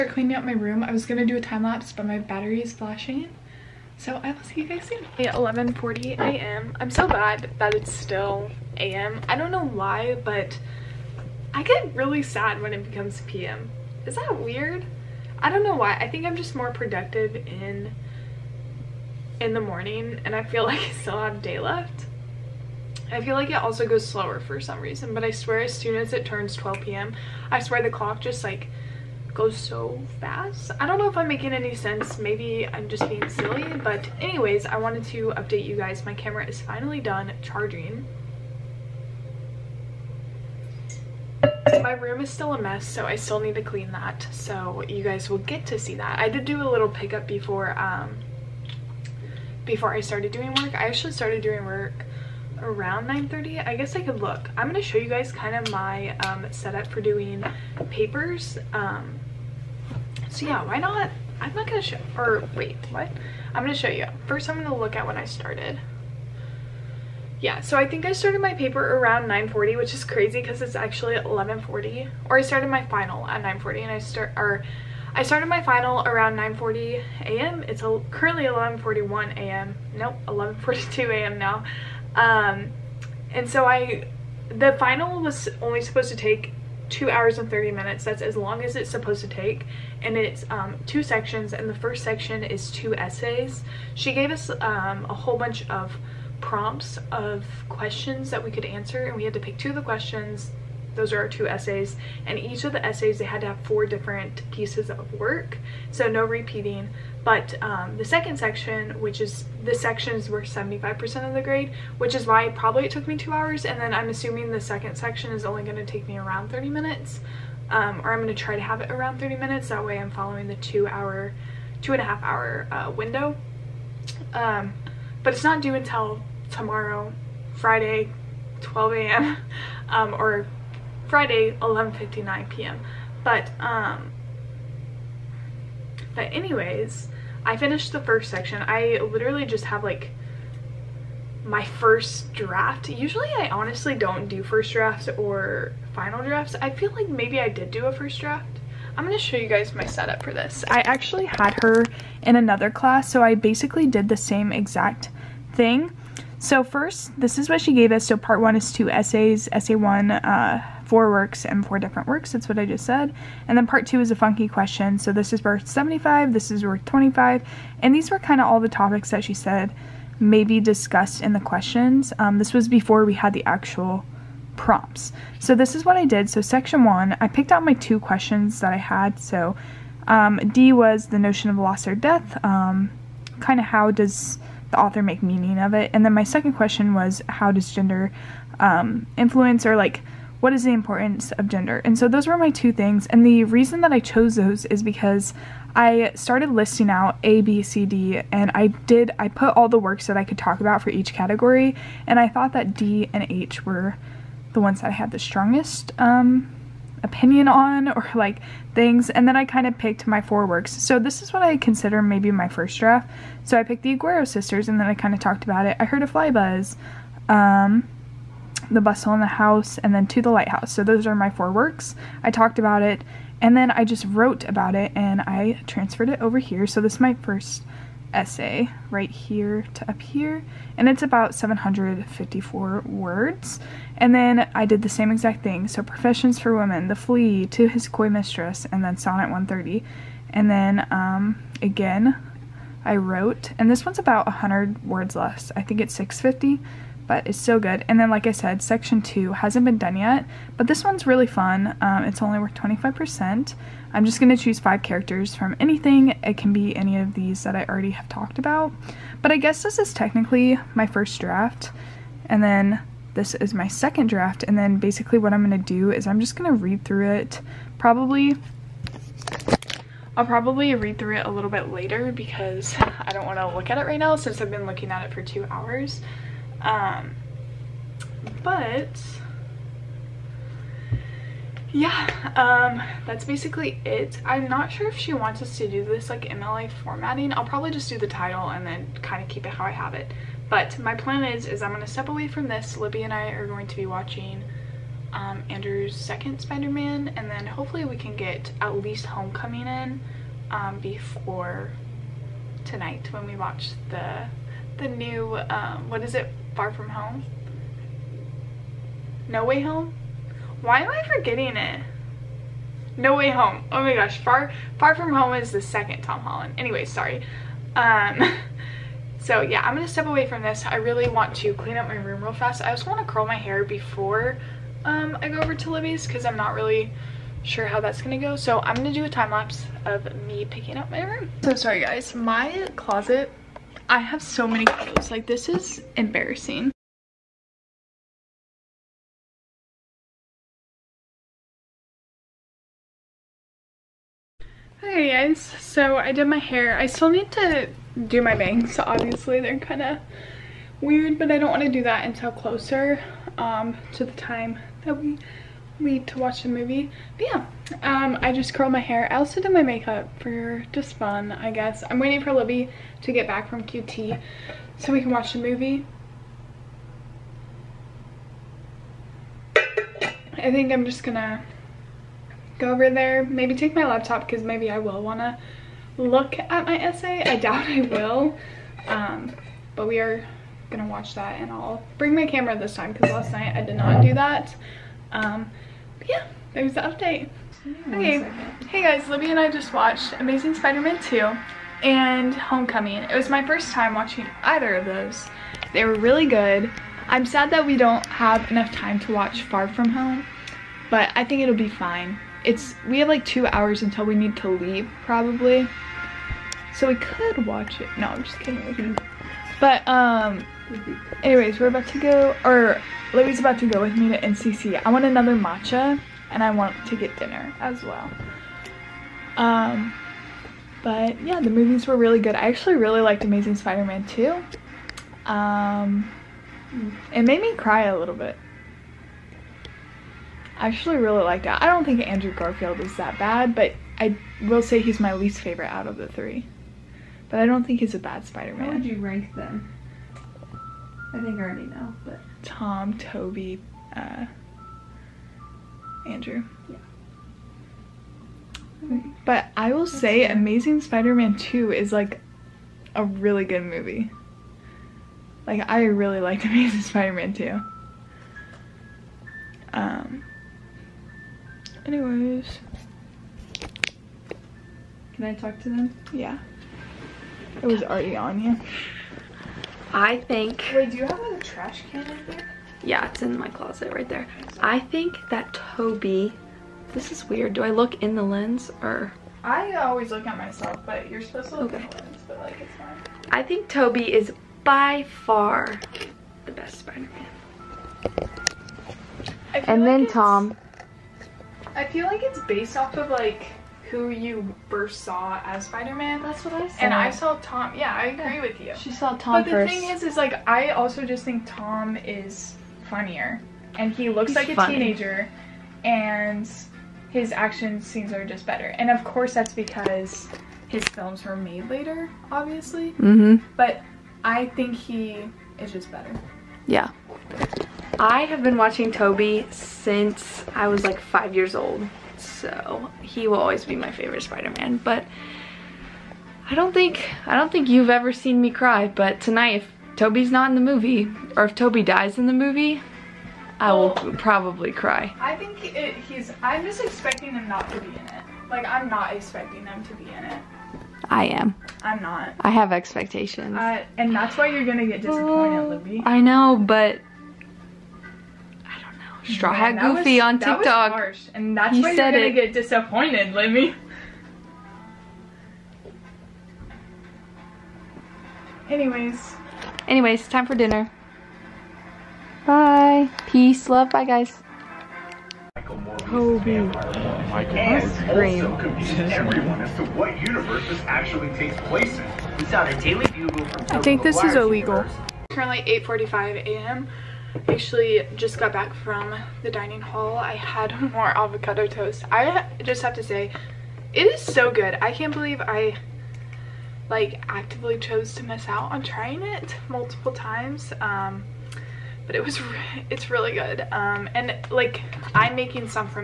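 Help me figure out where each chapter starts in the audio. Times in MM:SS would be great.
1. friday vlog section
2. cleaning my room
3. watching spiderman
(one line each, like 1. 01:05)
1. 09:34
2. 05:33
3. 05:44.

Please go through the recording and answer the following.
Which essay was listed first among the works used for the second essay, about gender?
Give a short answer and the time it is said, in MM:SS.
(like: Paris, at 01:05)
Professions for Women, at 03:55.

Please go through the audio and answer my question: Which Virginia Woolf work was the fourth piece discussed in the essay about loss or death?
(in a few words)
To the Lighthouse.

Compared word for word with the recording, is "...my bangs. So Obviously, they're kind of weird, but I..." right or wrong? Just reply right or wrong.
right.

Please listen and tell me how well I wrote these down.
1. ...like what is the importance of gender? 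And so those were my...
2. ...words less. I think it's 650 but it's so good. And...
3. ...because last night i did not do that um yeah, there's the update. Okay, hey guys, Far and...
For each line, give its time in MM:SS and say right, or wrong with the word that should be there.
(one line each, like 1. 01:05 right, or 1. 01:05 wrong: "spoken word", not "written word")
1. 03:09 right
2. 04:04 right
3. 06:22 wrong: "Libby", not "Far".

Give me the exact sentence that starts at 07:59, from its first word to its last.
I always look at myself, but you're supposed to look okay.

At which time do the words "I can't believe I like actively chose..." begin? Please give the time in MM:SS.
09:44.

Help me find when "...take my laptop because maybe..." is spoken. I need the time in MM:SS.
06:13.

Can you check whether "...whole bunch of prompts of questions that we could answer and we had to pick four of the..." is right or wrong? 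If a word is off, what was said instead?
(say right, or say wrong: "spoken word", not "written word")
wrong: "two", not "four".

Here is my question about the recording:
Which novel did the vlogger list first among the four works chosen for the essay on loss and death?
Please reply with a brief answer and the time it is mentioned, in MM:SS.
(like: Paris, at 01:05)
The Aguero Sisters, at 03:33.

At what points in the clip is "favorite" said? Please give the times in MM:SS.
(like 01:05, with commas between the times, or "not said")
07:15, 08:43.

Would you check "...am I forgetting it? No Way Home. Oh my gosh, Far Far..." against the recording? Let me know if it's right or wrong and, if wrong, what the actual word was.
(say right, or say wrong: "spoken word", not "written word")
right.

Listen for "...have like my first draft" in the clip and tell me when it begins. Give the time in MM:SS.
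02:19.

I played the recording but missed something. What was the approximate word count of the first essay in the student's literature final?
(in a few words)
754.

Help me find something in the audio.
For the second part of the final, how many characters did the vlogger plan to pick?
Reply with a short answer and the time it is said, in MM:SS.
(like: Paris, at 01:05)
5, at 04:14.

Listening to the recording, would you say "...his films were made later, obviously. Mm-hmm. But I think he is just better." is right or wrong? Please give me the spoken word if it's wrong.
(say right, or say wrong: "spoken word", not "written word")
right.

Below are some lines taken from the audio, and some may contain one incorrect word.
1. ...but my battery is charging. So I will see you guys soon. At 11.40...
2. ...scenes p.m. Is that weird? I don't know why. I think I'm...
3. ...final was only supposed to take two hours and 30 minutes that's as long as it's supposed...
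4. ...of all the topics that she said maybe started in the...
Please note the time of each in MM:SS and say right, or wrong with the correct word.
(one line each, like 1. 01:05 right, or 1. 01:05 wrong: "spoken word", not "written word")
1. 00:01 wrong: "flashing", not "charging"
2. 00:12 wrong: "becomes", not "scenes"
3. 01:24 right
4. 02:48 wrong: "discussed", not "started".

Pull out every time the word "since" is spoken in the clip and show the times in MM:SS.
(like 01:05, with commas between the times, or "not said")
04:34, 08:39.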